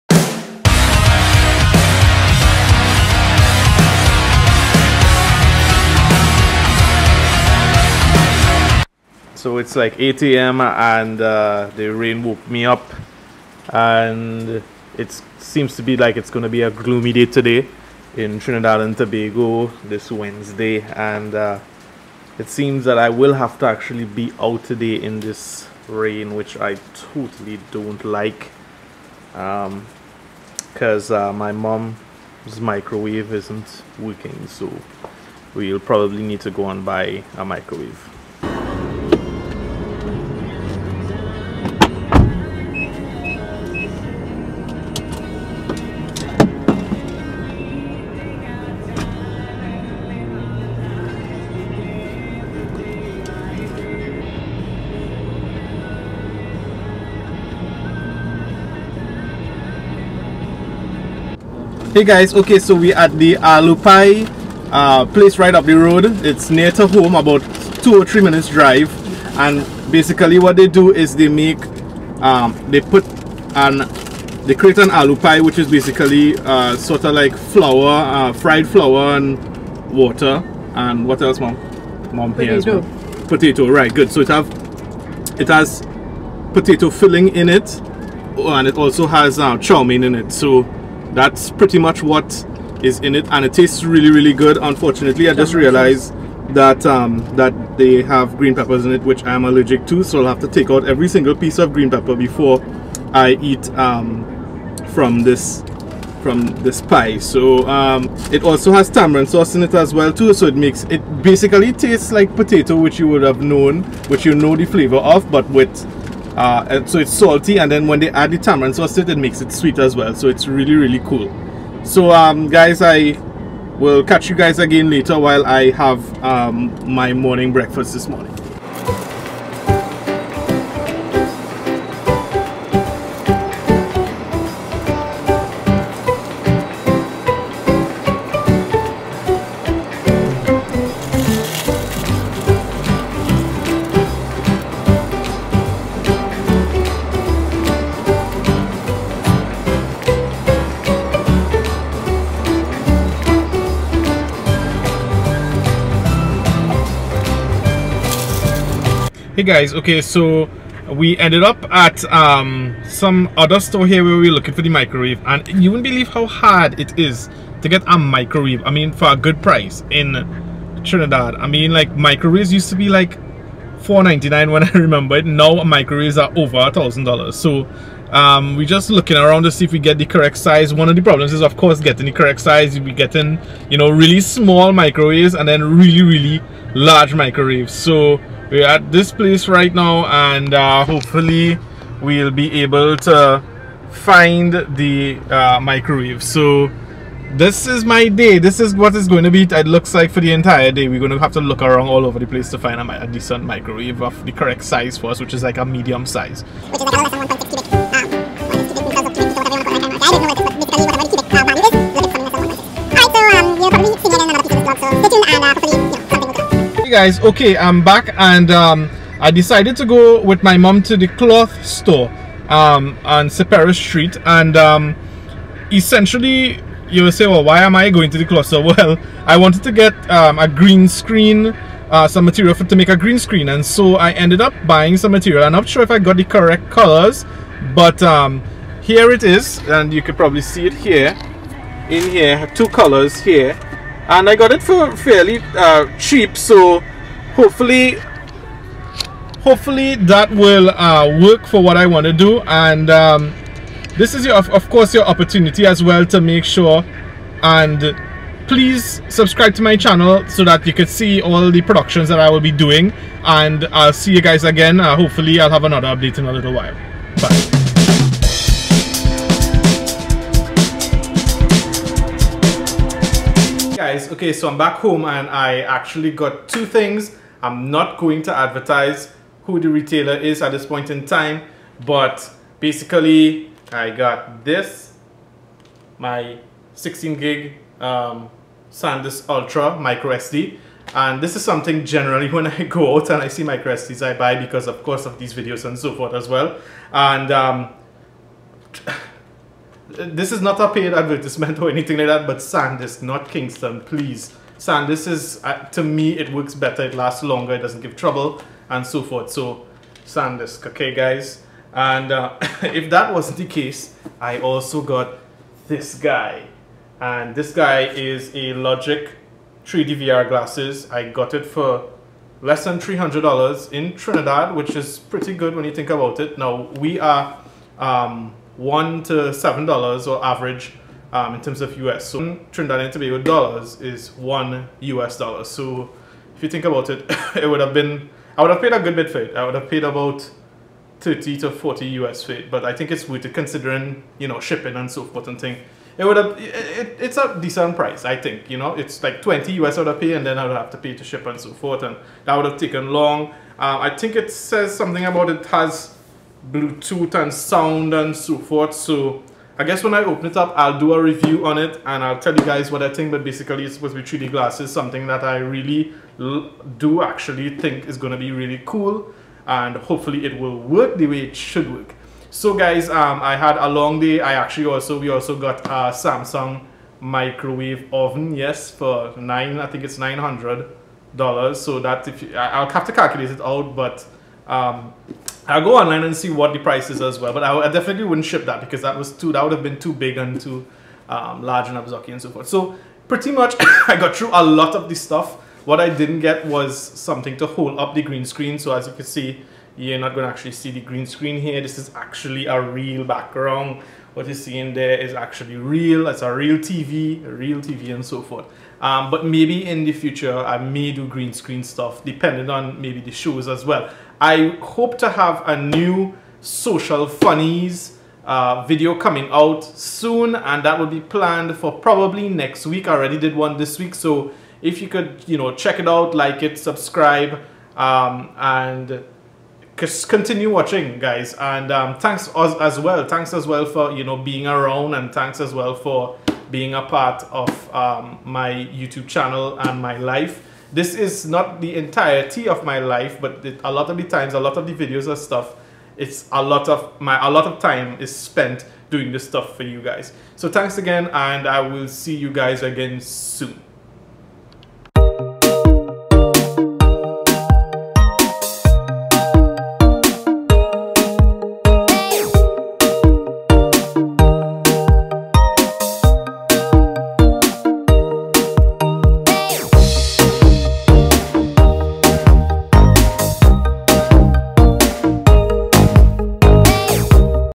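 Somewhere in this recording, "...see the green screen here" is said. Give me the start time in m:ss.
6:40.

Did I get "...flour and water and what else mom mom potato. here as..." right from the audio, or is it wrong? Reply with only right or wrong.
right.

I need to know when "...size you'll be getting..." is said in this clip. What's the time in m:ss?
3:02.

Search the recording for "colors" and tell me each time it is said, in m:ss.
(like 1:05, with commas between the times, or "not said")
3:56, 4:02.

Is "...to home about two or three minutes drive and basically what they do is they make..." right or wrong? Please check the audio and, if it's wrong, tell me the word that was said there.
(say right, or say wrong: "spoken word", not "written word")
right.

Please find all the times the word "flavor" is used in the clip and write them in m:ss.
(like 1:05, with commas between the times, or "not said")
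1:54.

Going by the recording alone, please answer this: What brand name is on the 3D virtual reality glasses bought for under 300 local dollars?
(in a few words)
Logic.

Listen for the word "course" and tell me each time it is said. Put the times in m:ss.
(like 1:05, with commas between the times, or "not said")
3:01, 4:14, 4:54.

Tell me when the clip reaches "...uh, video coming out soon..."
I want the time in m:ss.
6:58.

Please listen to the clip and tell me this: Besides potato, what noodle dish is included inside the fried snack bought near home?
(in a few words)
Chow mein.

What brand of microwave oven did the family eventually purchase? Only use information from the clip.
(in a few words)
Samsung.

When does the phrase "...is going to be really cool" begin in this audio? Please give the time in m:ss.
6:07.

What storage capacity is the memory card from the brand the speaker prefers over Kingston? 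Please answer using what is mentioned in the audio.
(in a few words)
16 gig.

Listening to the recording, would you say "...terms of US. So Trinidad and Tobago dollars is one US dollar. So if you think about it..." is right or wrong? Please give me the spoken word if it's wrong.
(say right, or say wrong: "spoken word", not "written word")
right.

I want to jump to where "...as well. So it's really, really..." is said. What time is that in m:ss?
1:59.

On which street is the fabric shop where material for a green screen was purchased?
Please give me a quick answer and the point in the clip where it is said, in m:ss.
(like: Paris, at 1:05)
Cipero Street, at 3:43.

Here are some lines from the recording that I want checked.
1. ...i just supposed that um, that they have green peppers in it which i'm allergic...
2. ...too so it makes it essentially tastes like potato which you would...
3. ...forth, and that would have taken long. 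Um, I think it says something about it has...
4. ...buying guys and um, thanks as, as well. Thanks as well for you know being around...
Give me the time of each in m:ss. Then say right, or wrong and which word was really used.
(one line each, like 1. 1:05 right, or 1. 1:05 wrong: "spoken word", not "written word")
1. 1:35 wrong: "realized", not "supposed"
2. 1:50 wrong: "basically", not "essentially"
3. 5:51 right
4. 7:10 wrong: "watching", not "buying".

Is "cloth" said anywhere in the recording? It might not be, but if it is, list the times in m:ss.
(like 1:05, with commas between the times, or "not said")
3:41, 3:48.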